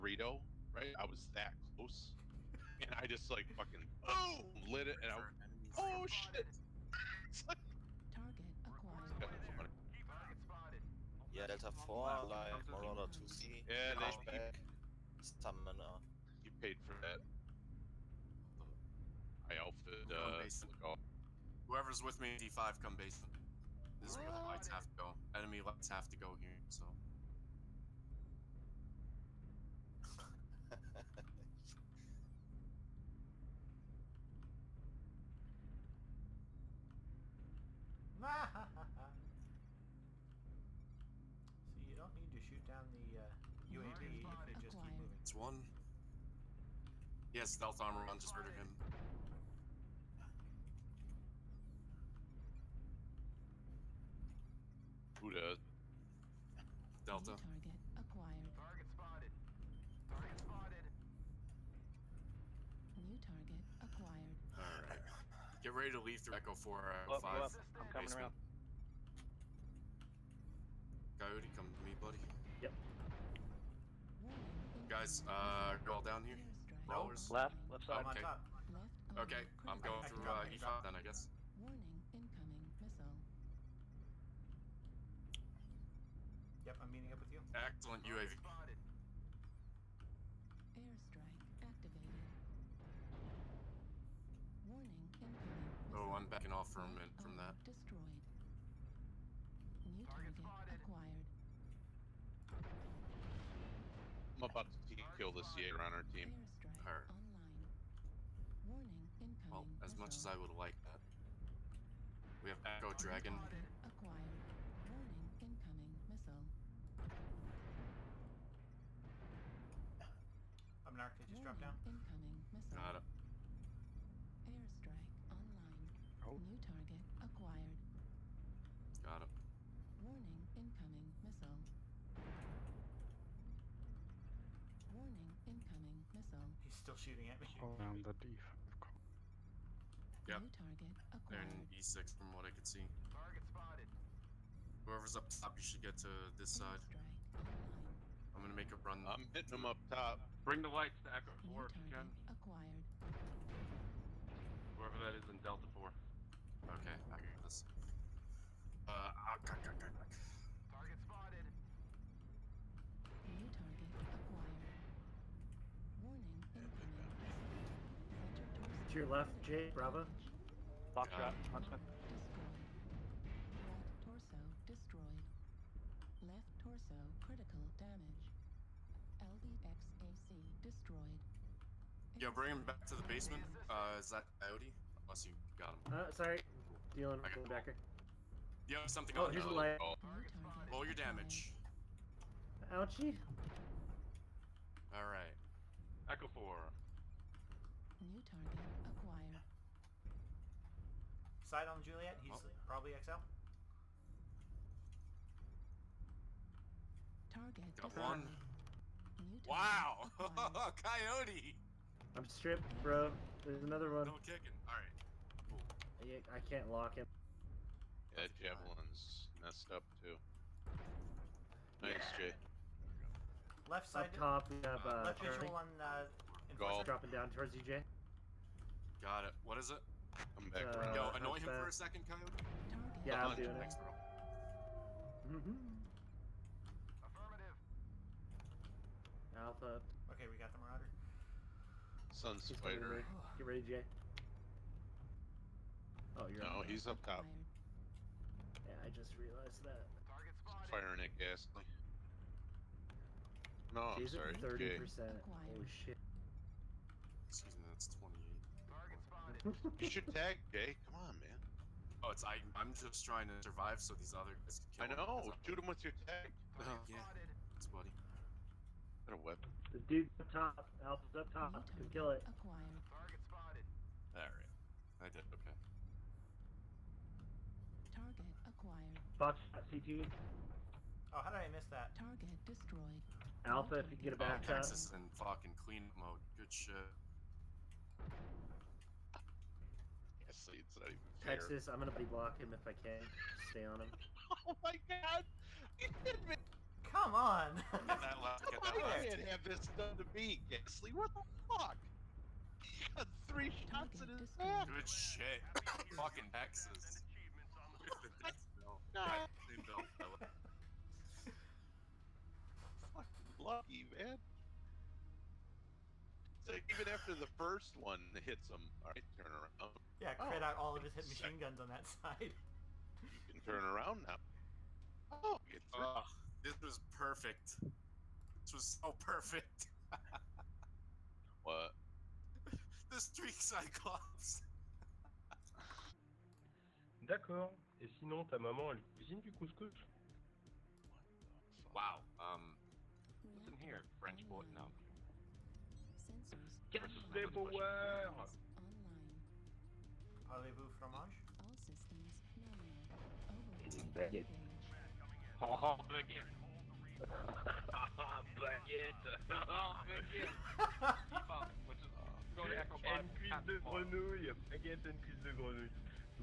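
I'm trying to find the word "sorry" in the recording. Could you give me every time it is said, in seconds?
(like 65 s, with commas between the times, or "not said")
186 s, 254 s.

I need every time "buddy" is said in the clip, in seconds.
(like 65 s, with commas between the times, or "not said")
71 s, 267 s.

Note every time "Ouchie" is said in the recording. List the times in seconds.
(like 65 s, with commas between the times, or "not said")
192 s.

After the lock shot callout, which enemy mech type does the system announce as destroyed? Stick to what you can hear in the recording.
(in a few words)
LDXAC.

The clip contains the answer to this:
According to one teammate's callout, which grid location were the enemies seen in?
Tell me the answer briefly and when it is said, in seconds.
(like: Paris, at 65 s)
E6, at 141 s.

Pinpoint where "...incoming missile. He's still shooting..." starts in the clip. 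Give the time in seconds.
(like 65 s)
135 s.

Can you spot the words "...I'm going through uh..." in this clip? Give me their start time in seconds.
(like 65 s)
79 s.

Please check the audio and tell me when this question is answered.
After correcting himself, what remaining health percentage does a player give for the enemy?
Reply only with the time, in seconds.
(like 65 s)
257 s.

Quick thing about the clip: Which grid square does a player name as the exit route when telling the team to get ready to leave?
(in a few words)
Echo 405.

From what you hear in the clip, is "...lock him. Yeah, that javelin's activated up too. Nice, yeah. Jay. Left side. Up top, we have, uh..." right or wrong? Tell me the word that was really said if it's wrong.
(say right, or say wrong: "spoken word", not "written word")
wrong: "messed", not "activated".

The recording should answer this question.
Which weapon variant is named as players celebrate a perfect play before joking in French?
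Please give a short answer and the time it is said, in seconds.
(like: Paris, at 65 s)
Streak Cyclops, at 332 s.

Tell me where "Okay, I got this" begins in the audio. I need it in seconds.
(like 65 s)
156 s.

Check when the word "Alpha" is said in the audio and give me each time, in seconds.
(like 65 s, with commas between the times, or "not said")
239 s, 270 s, 283 s.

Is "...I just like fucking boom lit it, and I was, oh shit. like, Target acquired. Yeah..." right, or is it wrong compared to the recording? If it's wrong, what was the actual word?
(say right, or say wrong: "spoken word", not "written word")
right.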